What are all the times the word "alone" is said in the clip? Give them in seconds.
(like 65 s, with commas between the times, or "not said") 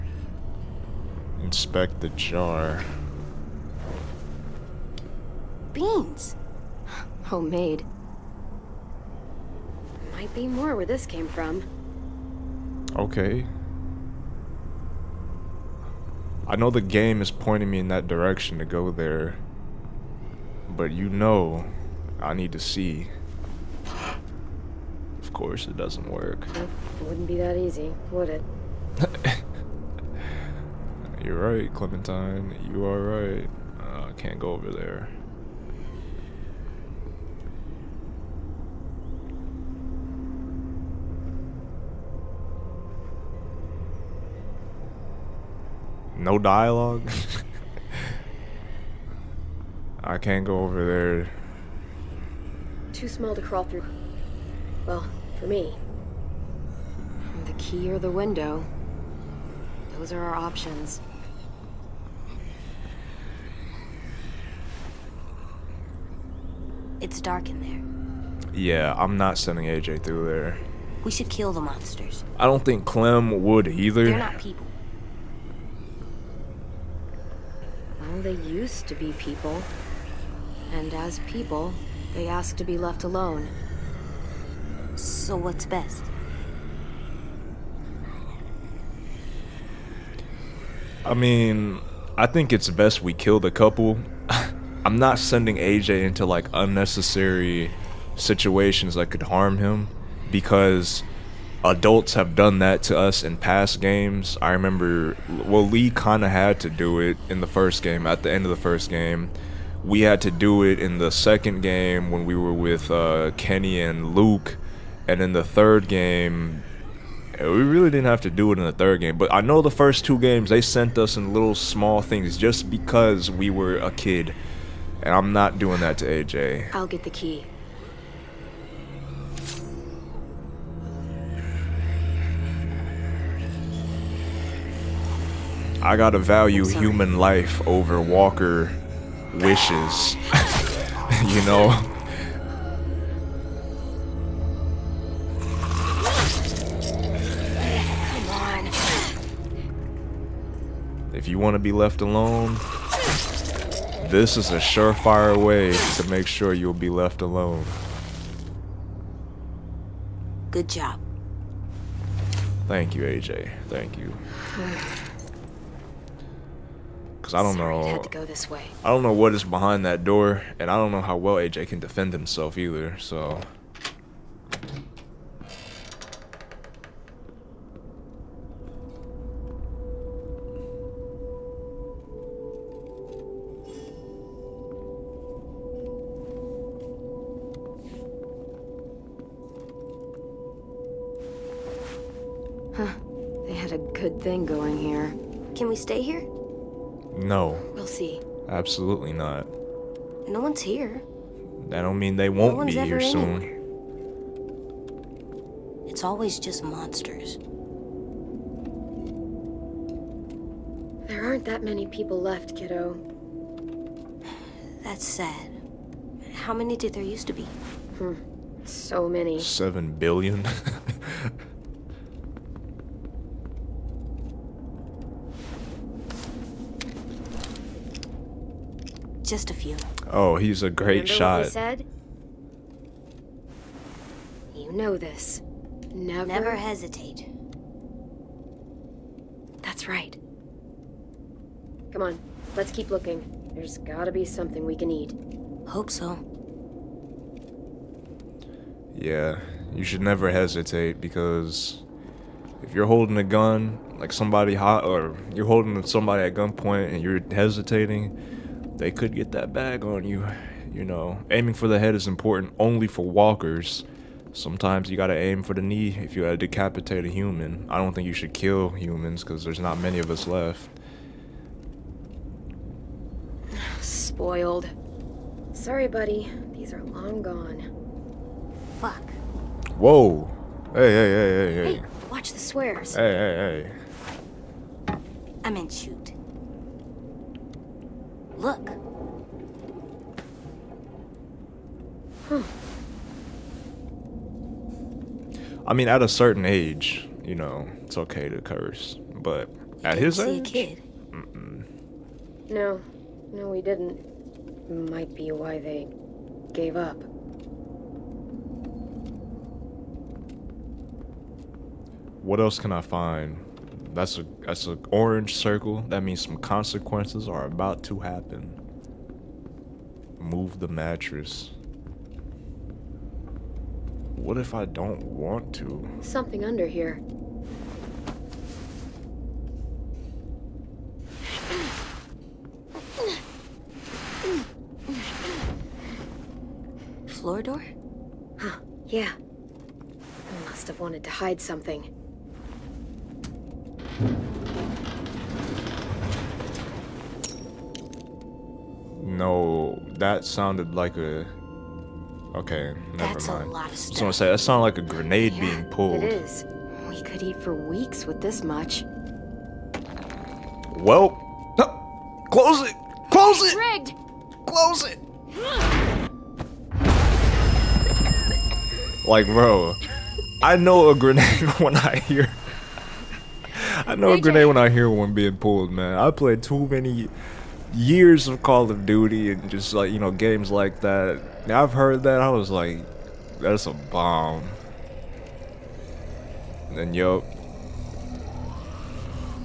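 83 s, 152 s, 157 s.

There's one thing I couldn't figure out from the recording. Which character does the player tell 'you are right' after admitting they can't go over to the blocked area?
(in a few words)
Clementine.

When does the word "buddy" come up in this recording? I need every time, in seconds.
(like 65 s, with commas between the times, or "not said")
275 s.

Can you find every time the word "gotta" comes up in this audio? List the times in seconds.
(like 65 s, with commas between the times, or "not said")
135 s, 243 s, 264 s.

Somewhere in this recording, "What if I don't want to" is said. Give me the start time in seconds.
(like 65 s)
324 s.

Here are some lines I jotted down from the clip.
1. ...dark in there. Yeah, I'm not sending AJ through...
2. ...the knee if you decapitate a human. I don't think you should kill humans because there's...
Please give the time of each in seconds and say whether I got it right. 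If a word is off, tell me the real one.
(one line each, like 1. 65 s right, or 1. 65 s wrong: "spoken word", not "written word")
1. 67 s right
2. 265 s right.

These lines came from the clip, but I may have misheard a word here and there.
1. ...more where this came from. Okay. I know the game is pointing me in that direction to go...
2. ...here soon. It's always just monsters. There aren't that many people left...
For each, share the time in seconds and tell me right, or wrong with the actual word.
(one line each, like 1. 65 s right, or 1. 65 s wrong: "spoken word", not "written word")
1. 10 s right
2. 202 s right.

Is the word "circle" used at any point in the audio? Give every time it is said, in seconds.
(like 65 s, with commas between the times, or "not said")
315 s.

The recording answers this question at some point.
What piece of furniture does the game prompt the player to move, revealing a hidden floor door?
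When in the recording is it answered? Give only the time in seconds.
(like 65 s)
320 s.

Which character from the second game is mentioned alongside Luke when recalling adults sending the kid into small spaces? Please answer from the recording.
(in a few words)
Kenny.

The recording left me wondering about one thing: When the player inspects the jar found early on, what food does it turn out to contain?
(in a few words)
Beans.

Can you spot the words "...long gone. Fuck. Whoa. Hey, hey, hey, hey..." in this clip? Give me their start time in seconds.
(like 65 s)
276 s.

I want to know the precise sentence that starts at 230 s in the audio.
Oh, he's a great Remember shot.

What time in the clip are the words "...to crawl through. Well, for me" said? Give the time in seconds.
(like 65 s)
53 s.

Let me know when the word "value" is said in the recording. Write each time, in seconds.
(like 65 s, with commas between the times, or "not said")
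136 s.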